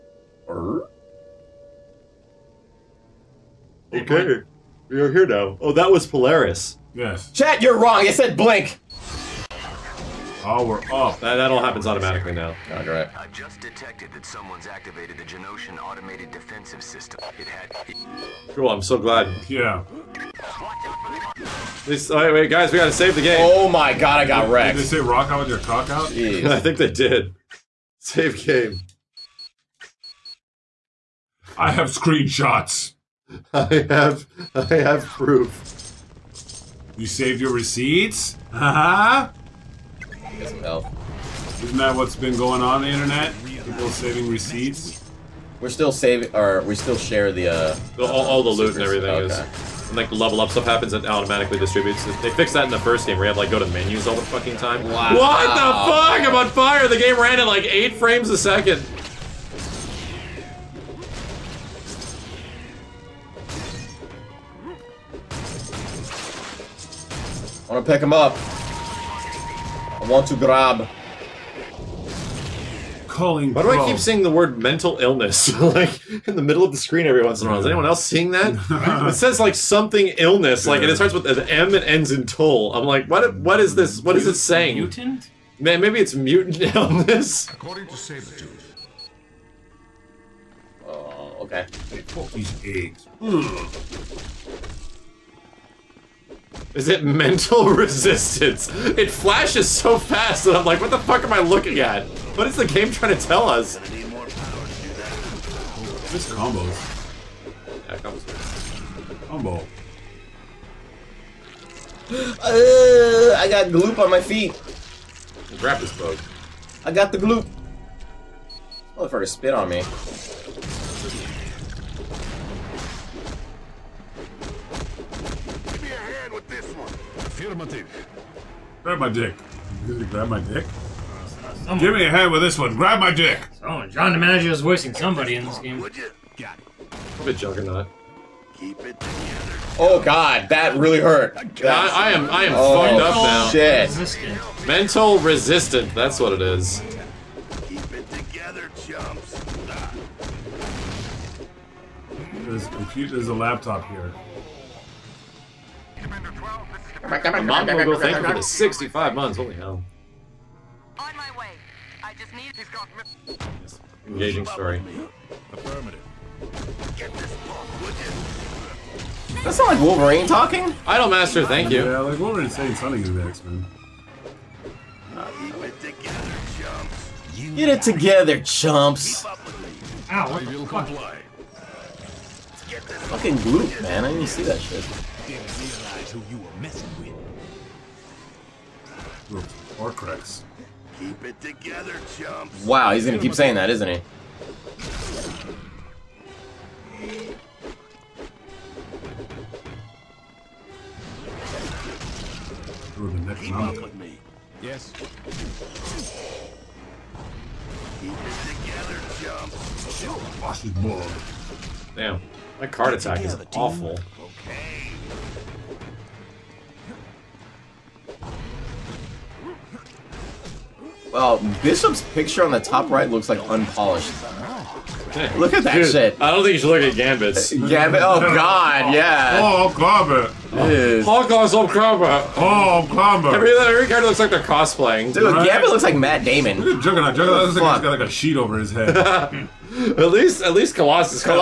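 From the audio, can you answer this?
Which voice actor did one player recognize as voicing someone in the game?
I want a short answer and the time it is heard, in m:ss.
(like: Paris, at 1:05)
John DiMaggio, at 2:13.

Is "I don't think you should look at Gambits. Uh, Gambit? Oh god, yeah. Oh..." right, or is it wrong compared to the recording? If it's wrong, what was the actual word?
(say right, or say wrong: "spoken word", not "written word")
right.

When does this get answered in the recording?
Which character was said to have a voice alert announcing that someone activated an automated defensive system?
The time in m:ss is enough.
0:06.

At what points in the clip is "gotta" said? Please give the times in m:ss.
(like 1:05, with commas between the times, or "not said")
0:22.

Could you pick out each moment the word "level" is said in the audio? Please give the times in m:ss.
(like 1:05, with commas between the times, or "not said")
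0:50.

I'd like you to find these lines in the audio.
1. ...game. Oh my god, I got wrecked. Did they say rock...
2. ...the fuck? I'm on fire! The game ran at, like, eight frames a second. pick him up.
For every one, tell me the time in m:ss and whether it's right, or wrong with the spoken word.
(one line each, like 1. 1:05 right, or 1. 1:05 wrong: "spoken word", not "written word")
1. 0:23 right
2. 0:55 right.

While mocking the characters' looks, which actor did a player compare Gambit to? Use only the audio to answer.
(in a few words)
Matt Damon.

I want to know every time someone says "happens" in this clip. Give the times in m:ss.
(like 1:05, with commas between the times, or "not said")
0:11, 0:50.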